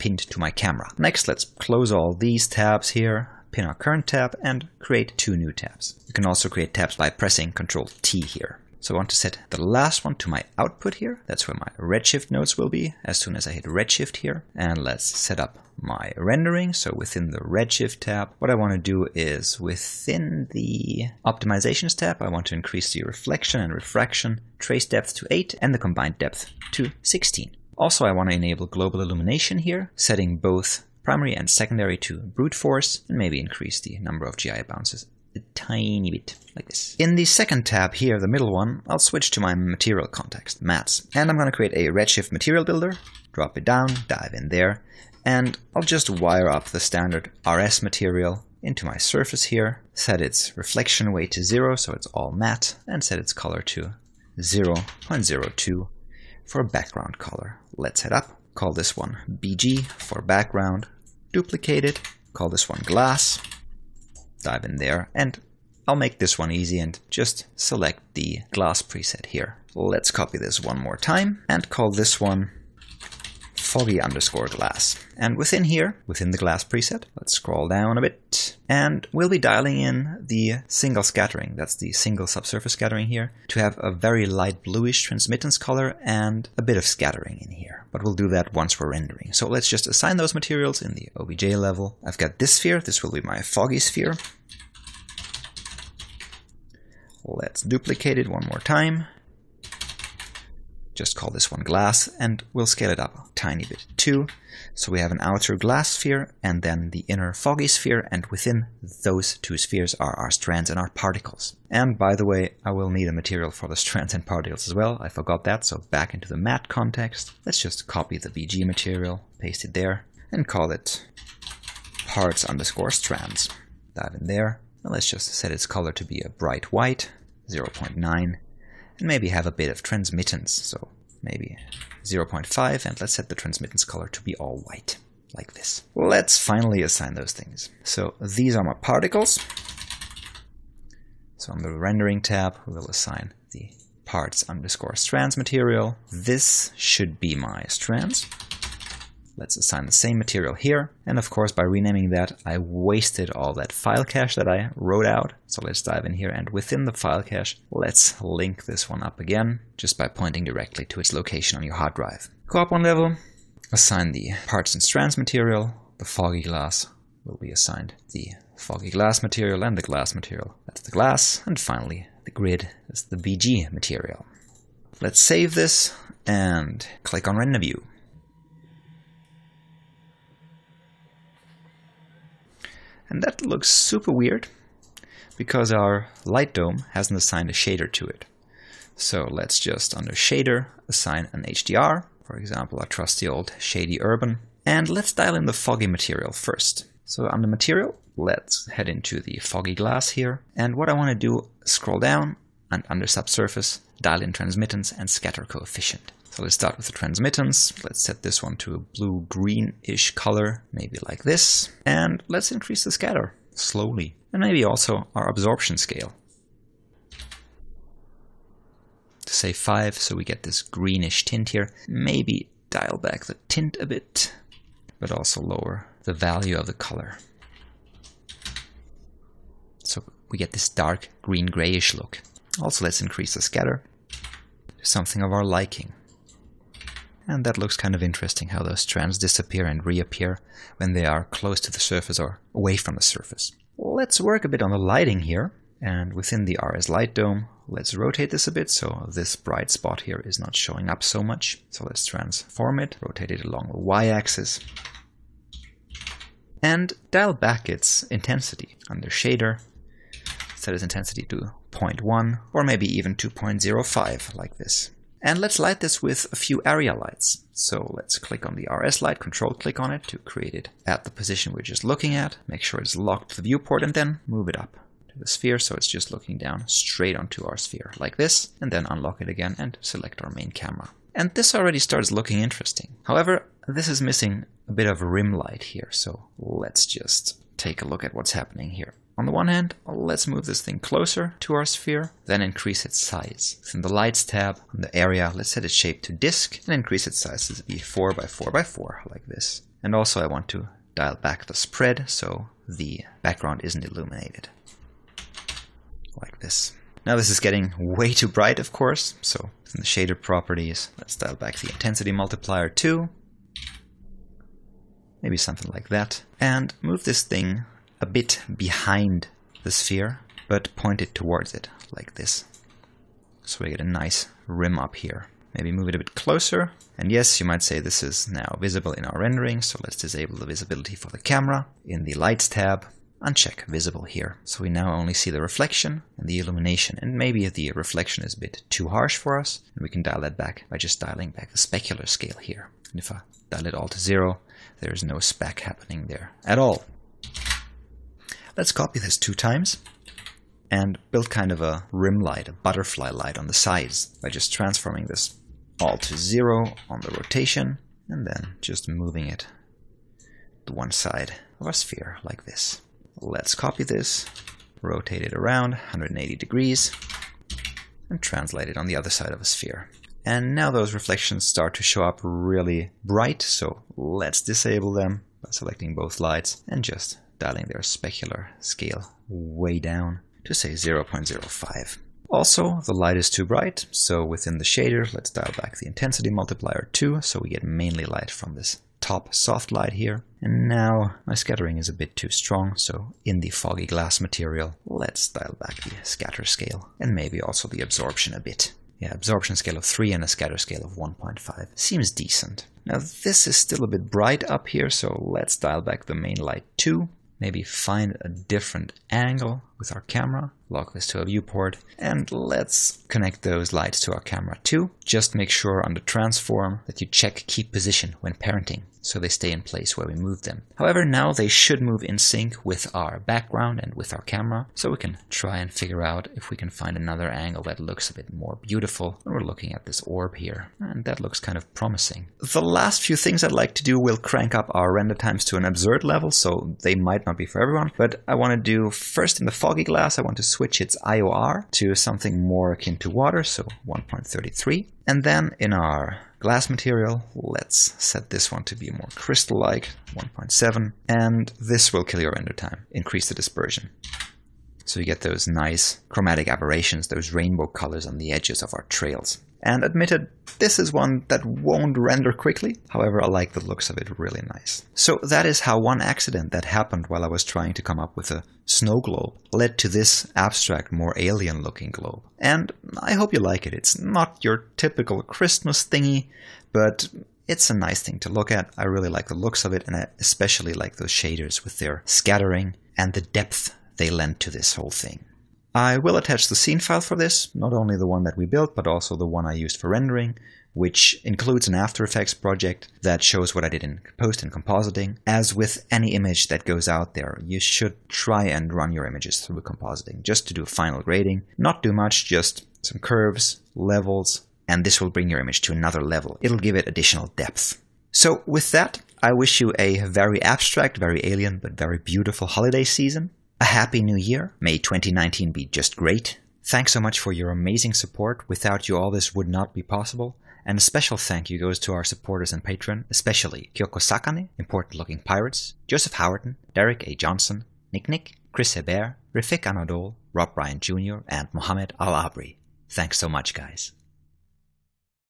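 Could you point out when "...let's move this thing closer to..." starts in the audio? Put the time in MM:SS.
04:49.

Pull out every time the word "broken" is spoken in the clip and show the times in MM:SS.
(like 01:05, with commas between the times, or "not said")
not said.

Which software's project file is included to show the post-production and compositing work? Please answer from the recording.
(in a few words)
After Effects.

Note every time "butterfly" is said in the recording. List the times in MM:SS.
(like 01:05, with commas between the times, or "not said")
05:52.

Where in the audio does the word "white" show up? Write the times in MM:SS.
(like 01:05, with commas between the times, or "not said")
02:06, 02:14.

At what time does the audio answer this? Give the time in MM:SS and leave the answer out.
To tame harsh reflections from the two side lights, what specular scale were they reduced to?
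06:20.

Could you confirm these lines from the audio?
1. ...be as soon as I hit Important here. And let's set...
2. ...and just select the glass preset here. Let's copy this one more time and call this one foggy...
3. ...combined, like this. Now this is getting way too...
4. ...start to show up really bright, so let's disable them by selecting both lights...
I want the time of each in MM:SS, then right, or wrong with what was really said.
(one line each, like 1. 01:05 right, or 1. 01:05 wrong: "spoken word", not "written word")
1. 00:12 wrong: "Redshift", not "Important"
2. 01:06 right
3. 05:03 wrong: "illuminated", not "combined"
4. 06:11 right.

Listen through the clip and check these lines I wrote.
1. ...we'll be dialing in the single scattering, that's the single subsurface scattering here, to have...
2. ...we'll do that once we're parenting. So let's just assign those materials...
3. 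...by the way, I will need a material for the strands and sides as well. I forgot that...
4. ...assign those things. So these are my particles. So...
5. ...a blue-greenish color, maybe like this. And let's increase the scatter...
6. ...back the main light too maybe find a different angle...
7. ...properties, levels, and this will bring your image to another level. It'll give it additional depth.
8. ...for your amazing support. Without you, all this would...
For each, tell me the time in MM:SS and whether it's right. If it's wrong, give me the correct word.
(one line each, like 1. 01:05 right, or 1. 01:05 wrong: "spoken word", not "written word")
1. 01:19 right
2. 01:28 wrong: "rendering", not "parenting"
3. 01:51 wrong: "particles", not "sides"
4. 02:16 right
5. 03:28 right
6. 06:45 right
7. 08:22 wrong: "curves", not "properties"
8. 08:37 right.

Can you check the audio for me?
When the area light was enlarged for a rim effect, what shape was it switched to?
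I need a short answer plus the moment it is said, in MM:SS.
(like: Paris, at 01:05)
disk, at 04:56.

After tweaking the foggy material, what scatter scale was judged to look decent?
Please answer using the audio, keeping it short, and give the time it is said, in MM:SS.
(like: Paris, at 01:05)
1.5, at 06:40.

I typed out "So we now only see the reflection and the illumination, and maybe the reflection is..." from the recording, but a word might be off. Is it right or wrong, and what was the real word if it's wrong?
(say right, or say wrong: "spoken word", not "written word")
right.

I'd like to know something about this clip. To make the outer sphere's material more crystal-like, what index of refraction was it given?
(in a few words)
1.7.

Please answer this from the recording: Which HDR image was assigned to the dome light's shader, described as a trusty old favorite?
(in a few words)
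shady urban.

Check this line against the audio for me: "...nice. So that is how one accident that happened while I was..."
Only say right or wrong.
right.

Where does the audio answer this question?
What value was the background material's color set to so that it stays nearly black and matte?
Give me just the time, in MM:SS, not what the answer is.
00:54.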